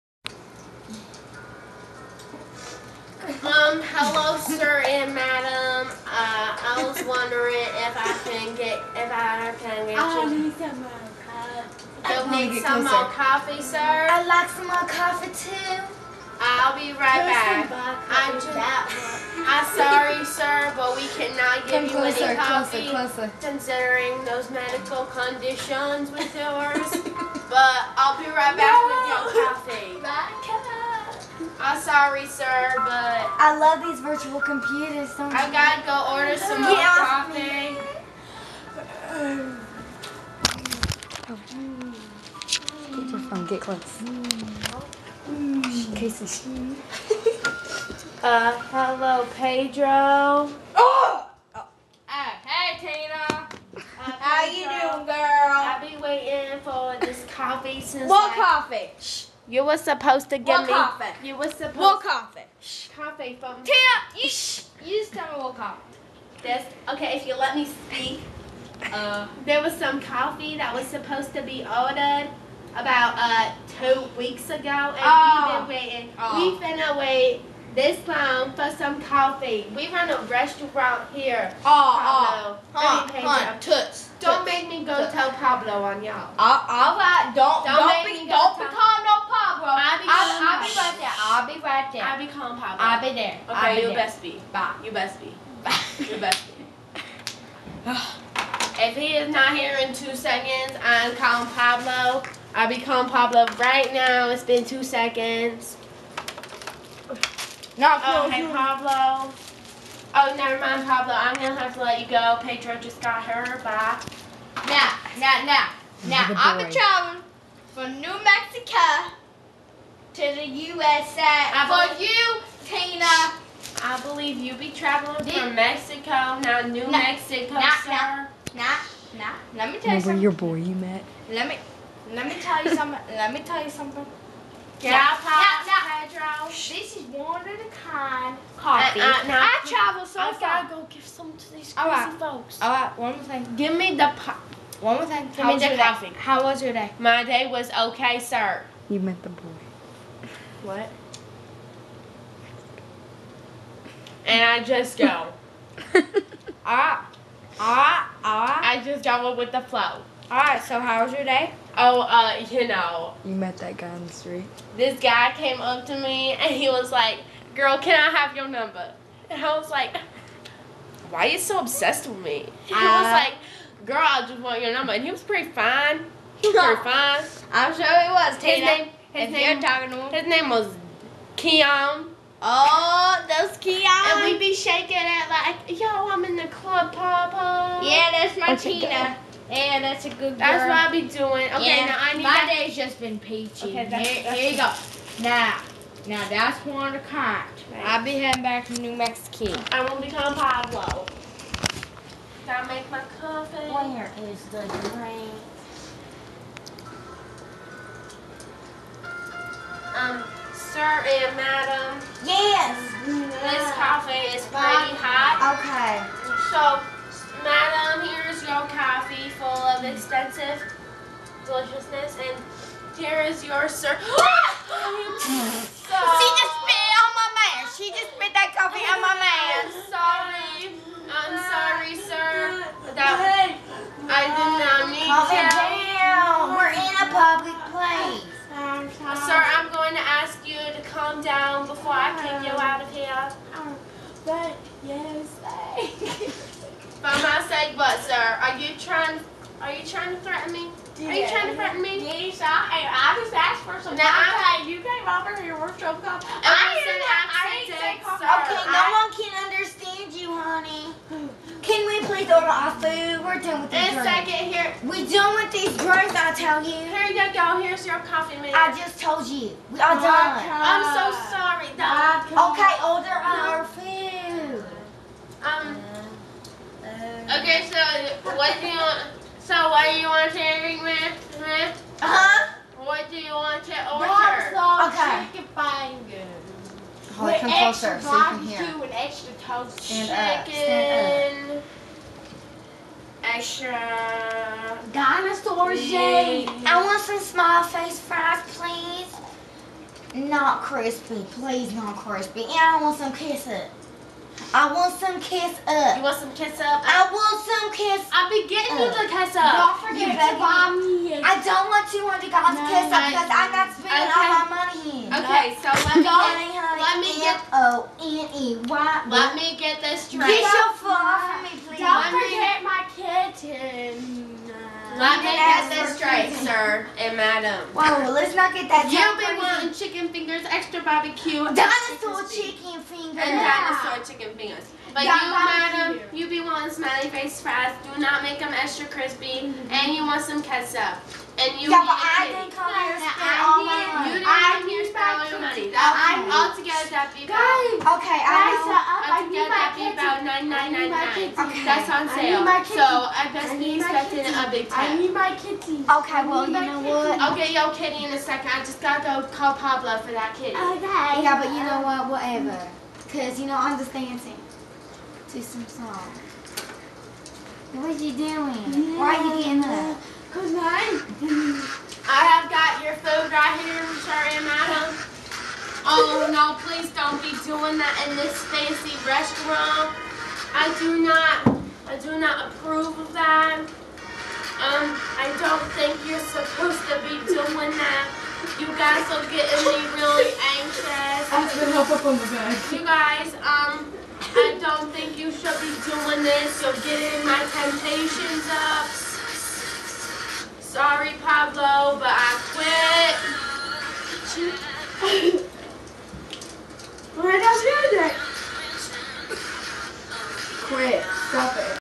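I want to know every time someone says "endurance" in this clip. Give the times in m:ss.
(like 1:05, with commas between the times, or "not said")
not said.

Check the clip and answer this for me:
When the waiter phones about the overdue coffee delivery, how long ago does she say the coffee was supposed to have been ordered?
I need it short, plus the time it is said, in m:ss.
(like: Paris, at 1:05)
2 weeks, at 1:13.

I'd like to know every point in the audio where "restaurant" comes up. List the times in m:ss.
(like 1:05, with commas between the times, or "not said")
1:20, 6:19.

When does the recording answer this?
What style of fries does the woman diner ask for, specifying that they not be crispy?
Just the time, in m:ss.
5:36.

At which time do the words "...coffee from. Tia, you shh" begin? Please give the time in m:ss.
1:02.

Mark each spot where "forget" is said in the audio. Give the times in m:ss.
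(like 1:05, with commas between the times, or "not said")
5:09, 5:22.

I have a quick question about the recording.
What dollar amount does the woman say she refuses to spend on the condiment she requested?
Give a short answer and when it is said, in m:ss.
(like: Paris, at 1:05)
$200, at 5:11.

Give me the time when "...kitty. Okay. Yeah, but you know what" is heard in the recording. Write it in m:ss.
6:00.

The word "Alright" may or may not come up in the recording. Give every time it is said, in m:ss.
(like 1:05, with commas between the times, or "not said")
2:40.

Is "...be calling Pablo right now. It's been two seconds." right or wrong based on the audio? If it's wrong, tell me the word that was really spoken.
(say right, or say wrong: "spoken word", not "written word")
right.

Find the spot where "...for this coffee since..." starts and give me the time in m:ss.
0:56.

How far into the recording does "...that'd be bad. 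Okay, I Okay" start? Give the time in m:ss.
5:46.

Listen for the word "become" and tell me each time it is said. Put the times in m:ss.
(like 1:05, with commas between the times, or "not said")
1:28, 3:20.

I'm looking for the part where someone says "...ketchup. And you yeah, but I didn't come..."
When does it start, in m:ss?
5:40.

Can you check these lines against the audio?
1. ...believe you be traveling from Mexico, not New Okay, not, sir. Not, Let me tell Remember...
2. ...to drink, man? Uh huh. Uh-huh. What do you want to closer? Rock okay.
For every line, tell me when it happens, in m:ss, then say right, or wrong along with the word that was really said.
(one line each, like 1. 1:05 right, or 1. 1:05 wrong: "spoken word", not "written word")
1. 2:04 wrong: "Mexico", not "Okay"
2. 4:40 wrong: "order", not "closer".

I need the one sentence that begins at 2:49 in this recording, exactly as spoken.
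And I was like, Why are you so obsessed with me?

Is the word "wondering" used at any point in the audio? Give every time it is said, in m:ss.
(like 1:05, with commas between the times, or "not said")
0:07.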